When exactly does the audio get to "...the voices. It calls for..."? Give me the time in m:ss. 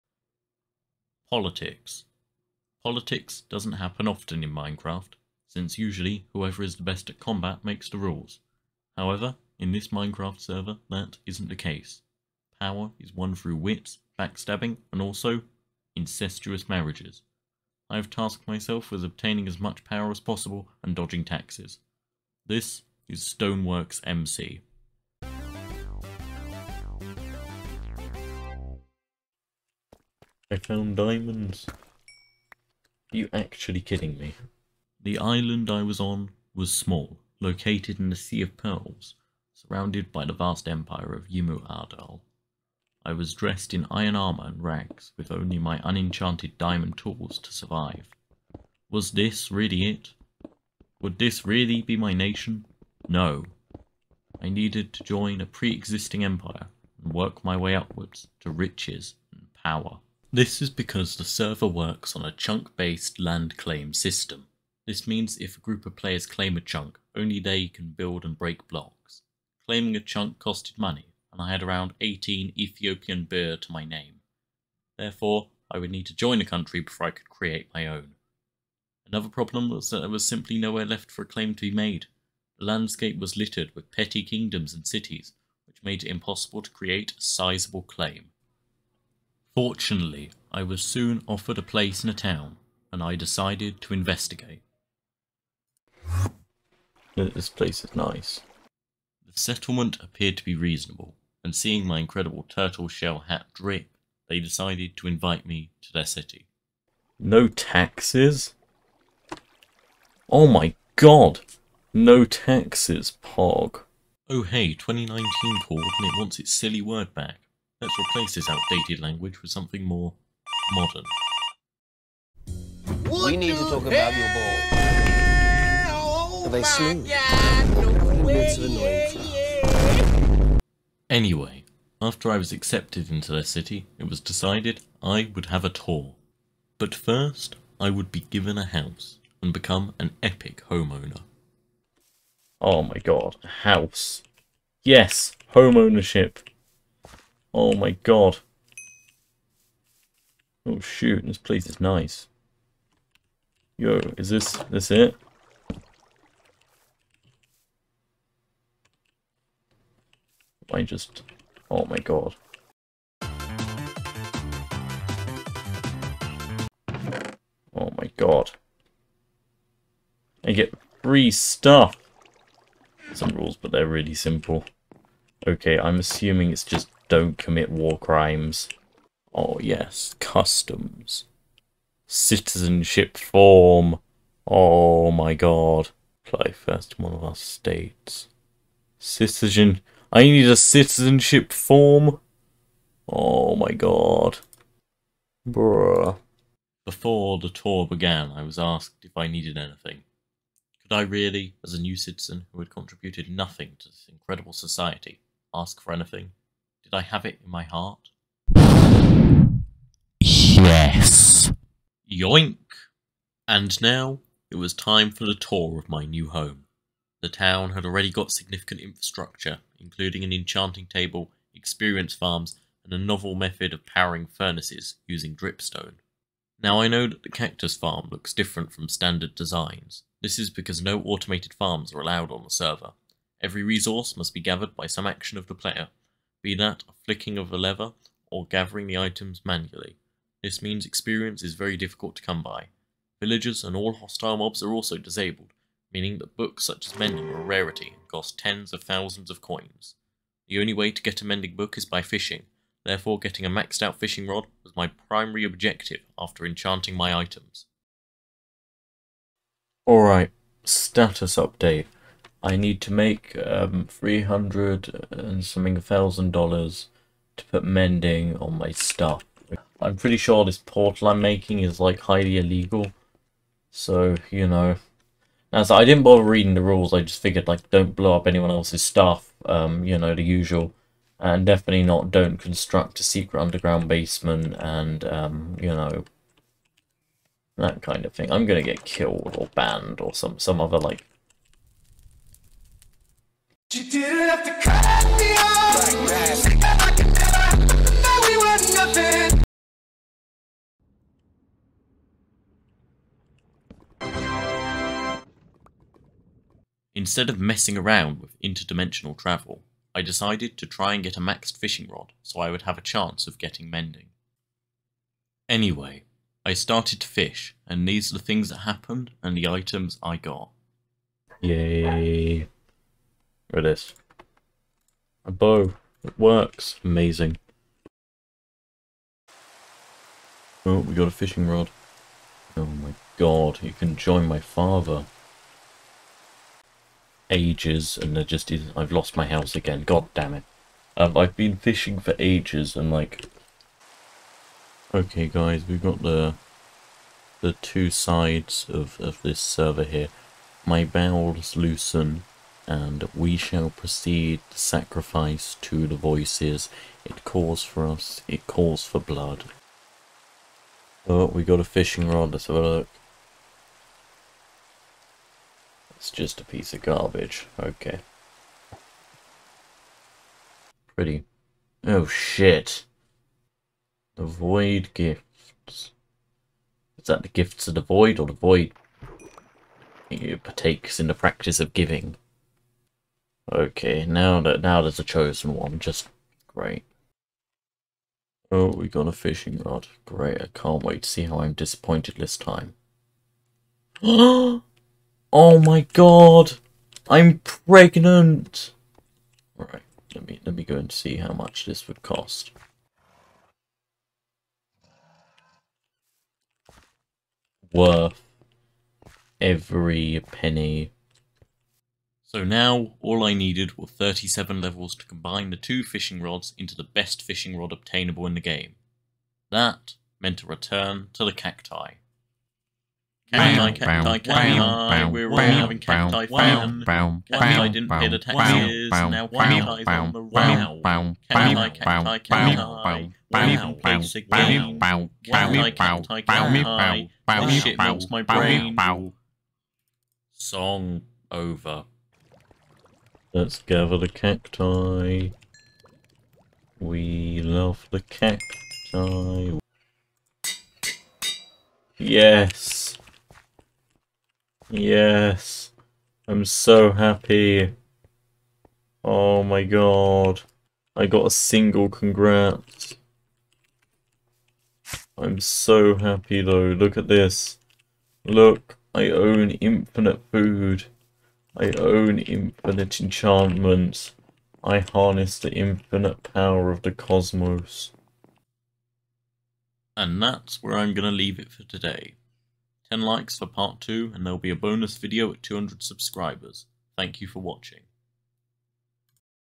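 5:55.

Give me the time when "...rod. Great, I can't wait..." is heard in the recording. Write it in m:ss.
6:29.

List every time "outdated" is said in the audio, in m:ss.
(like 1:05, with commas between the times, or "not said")
1:58.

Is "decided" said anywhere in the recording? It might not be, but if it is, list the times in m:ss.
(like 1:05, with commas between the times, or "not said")
1:33, 1:44, 2:14, 5:10.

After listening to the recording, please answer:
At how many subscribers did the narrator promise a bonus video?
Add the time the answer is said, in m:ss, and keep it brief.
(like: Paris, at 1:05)
200, at 8:05.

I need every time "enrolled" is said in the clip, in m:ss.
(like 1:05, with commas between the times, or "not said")
not said.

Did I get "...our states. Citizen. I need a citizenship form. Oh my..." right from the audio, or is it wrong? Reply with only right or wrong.
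right.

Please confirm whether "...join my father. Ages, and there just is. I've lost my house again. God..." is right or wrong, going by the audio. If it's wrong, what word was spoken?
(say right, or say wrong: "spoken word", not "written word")
right.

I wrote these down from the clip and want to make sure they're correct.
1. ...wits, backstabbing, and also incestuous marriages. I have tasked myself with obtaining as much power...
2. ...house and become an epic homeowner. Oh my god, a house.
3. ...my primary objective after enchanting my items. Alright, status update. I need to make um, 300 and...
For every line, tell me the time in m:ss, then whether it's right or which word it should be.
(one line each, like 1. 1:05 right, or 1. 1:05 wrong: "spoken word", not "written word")
1. 0:13 right
2. 2:18 right
3. 4:14 right.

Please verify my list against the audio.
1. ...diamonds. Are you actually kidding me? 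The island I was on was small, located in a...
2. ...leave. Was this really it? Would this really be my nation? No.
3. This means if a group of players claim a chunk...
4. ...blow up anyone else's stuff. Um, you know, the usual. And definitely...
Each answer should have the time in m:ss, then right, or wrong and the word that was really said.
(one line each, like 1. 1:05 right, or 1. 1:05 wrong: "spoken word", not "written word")
1. 0:30 right
2. 0:47 wrong: "survive", not "leave"
3. 1:04 right
4. 4:37 right.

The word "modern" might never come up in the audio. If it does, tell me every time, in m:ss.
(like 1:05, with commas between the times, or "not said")
2:00.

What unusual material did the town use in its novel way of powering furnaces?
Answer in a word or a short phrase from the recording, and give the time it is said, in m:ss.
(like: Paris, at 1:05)
dripstone, at 3:45.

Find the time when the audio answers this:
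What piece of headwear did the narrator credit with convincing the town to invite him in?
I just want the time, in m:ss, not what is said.
1:42.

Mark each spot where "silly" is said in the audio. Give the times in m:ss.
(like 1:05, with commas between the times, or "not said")
1:56.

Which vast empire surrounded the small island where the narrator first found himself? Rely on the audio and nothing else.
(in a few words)
Yimu Ardal.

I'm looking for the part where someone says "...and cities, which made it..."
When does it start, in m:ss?
1:24.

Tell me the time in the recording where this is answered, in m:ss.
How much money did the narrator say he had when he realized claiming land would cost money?
1:11.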